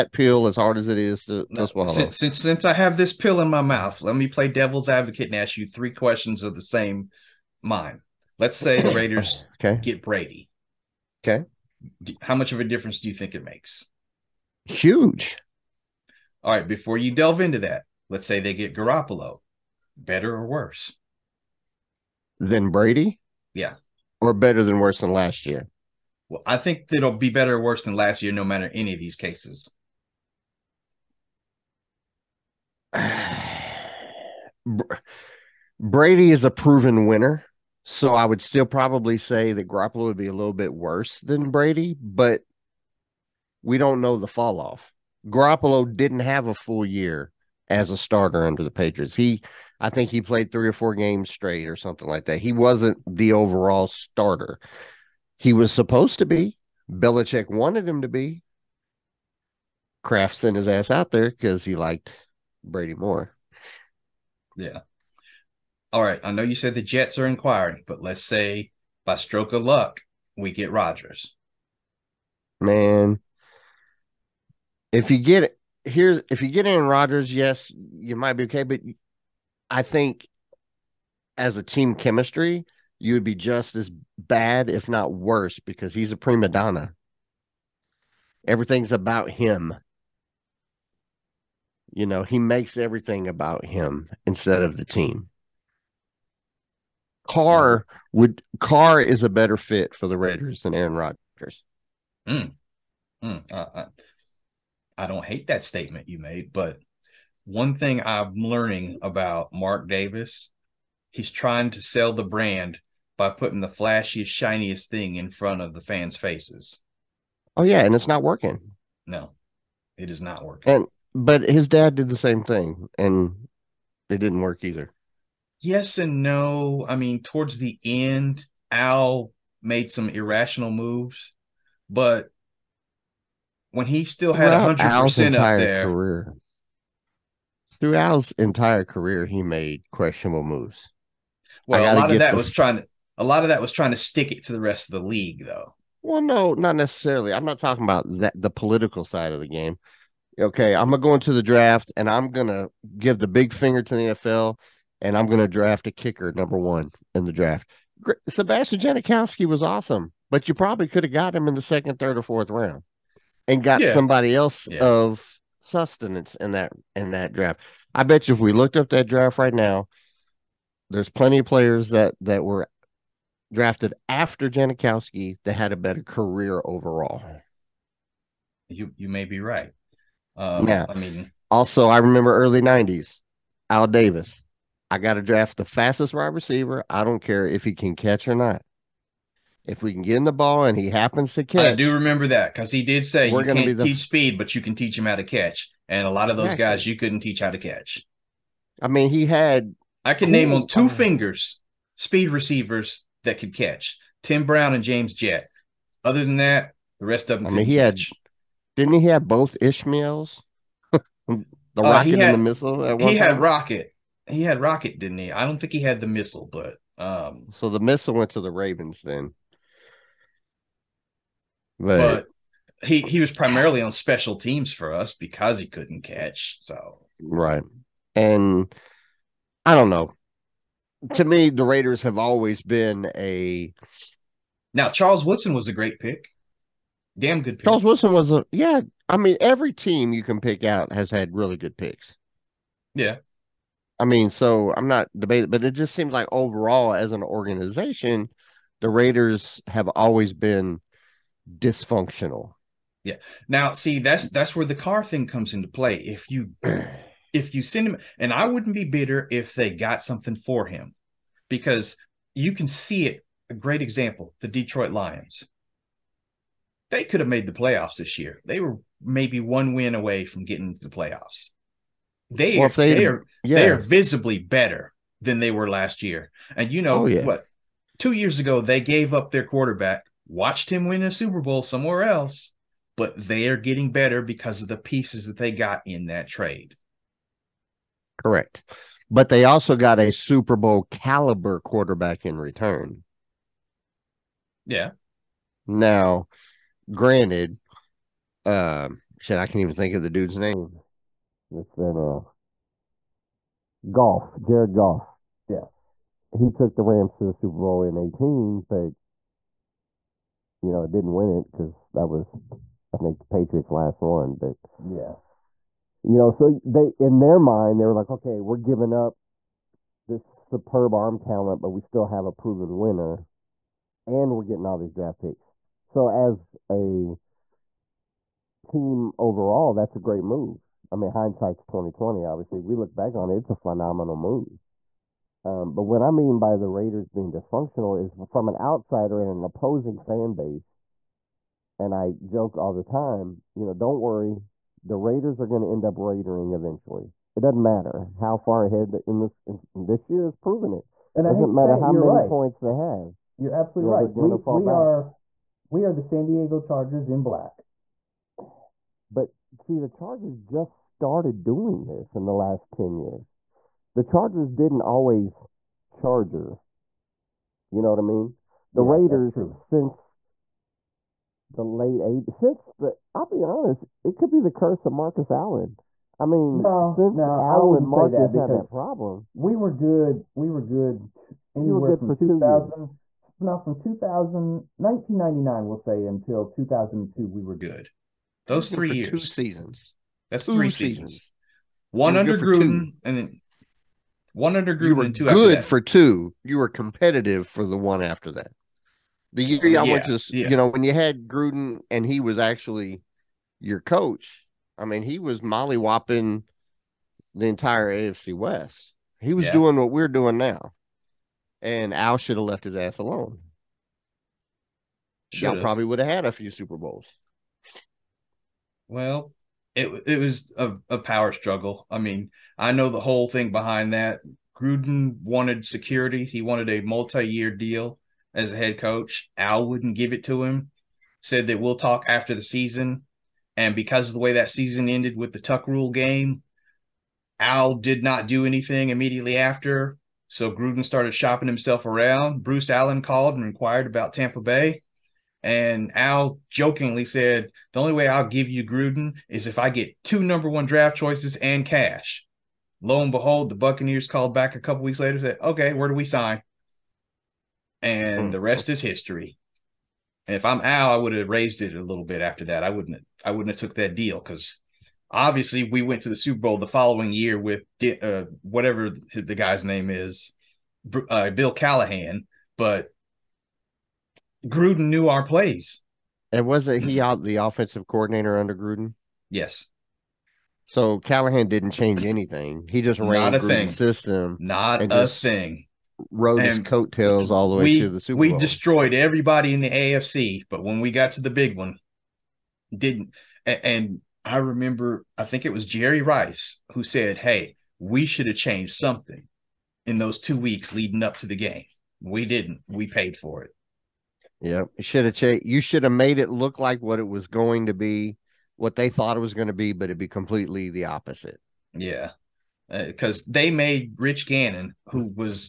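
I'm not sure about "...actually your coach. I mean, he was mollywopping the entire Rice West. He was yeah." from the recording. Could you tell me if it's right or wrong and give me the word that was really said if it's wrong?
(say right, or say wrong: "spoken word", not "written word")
wrong: "AFC", not "Rice".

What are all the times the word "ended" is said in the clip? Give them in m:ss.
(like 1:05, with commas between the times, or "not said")
7:14.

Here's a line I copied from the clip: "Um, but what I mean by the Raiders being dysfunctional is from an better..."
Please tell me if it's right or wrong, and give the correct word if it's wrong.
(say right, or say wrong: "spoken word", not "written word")
wrong: "outsider", not "better".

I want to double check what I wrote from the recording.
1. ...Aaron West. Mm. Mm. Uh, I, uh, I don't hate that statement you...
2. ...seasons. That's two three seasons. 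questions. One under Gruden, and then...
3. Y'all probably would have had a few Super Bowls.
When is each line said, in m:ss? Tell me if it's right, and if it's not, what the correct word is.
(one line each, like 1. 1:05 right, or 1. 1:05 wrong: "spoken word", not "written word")
1. 1:40 wrong: "Rodgers", not "West"
2. 6:29 wrong: "seasons", not "questions"
3. 6:55 right.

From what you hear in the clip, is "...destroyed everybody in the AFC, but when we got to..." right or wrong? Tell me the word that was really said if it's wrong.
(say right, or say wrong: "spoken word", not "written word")
right.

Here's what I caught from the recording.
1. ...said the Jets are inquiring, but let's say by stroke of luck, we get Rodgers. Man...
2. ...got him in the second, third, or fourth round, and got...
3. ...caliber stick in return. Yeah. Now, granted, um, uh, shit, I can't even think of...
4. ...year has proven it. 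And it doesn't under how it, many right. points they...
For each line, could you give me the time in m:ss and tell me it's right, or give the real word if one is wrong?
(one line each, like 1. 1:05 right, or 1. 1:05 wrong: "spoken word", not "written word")
1. 1:06 right
2. 2:41 right
3. 4:50 wrong: "quarterback", not "stick"
4. 5:50 wrong: "matter", not "under".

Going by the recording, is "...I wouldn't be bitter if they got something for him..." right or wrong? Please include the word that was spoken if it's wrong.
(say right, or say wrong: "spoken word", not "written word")
right.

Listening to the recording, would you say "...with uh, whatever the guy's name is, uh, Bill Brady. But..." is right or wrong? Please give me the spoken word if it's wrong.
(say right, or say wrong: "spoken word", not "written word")
wrong: "Callahan", not "Brady".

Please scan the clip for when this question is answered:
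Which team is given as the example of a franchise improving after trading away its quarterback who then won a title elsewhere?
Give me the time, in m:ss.
4:24.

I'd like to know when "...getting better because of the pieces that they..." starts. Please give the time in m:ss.
4:43.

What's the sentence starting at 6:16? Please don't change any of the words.
I mean, no, since no, Allen Marcus say that had that problem.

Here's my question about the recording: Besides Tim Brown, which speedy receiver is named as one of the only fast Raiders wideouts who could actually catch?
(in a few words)
James Jett.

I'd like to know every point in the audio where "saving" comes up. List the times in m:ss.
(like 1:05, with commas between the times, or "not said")
not said.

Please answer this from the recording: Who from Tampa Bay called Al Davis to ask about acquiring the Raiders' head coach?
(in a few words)
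Bruce Allen.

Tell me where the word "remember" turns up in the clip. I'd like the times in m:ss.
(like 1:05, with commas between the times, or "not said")
3:01, 3:11, 8:14.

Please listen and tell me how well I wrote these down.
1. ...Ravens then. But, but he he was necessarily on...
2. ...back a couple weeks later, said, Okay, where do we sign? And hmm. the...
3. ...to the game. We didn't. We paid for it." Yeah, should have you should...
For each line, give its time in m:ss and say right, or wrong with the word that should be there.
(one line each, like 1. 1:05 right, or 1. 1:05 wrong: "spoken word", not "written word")
1. 3:38 wrong: "primarily", not "necessarily"
2. 7:34 right
3. 8:21 right.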